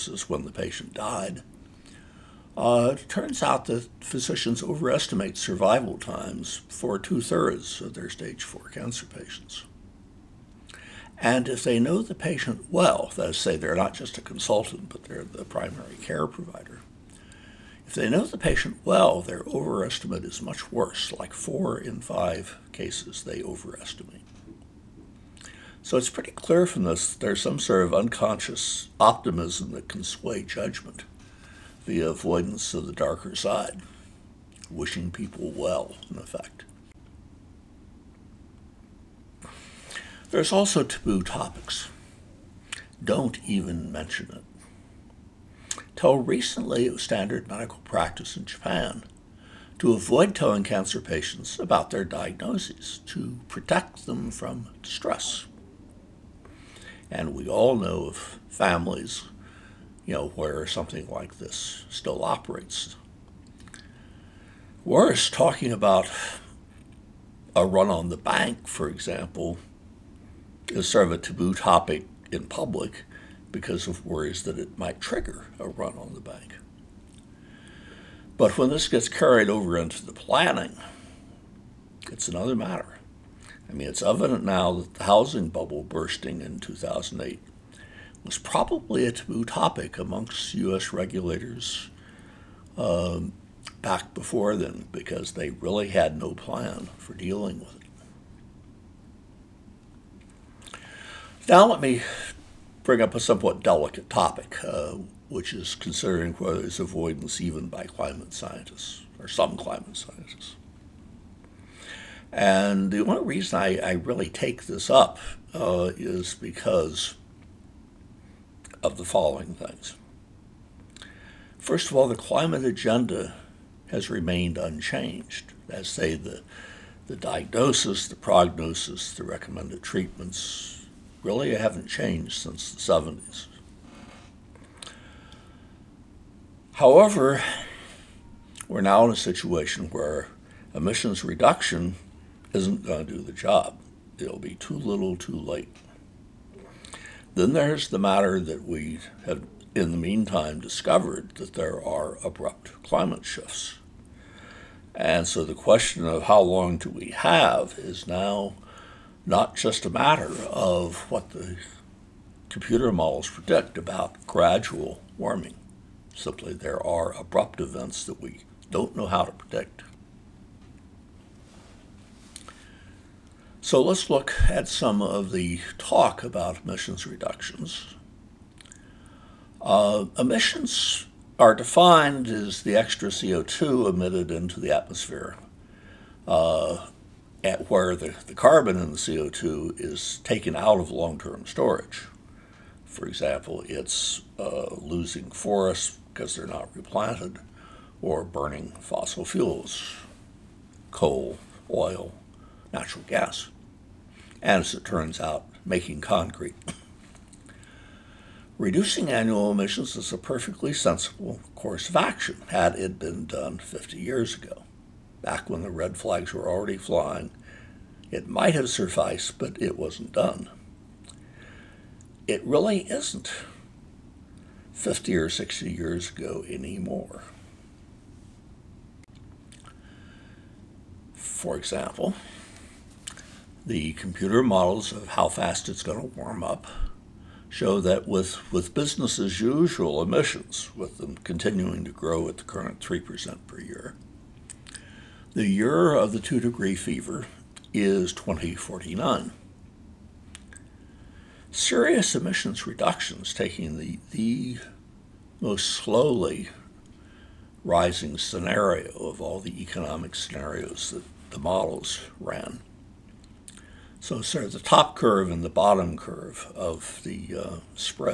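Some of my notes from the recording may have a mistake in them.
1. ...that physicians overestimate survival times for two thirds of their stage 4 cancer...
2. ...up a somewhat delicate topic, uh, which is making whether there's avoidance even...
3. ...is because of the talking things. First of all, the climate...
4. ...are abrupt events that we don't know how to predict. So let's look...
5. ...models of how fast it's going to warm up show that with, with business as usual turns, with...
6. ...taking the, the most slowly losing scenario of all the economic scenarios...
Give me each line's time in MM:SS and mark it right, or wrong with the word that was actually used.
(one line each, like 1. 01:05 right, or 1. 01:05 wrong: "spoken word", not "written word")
1. 00:03 right
2. 01:43 wrong: "considering", not "making"
3. 01:55 wrong: "following", not "talking"
4. 02:46 right
5. 03:54 wrong: "emissions", not "turns"
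6. 04:13 wrong: "rising", not "losing".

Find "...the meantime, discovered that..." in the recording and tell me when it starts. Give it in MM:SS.
02:29.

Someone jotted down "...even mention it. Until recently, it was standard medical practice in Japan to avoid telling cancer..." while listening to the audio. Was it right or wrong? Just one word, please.
right.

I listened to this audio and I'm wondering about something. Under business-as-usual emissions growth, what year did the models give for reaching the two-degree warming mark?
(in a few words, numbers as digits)
2049.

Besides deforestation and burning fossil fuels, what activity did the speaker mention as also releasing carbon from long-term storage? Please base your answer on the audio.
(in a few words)
making concrete.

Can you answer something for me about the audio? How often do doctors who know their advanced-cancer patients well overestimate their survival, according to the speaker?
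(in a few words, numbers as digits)
4 in 5.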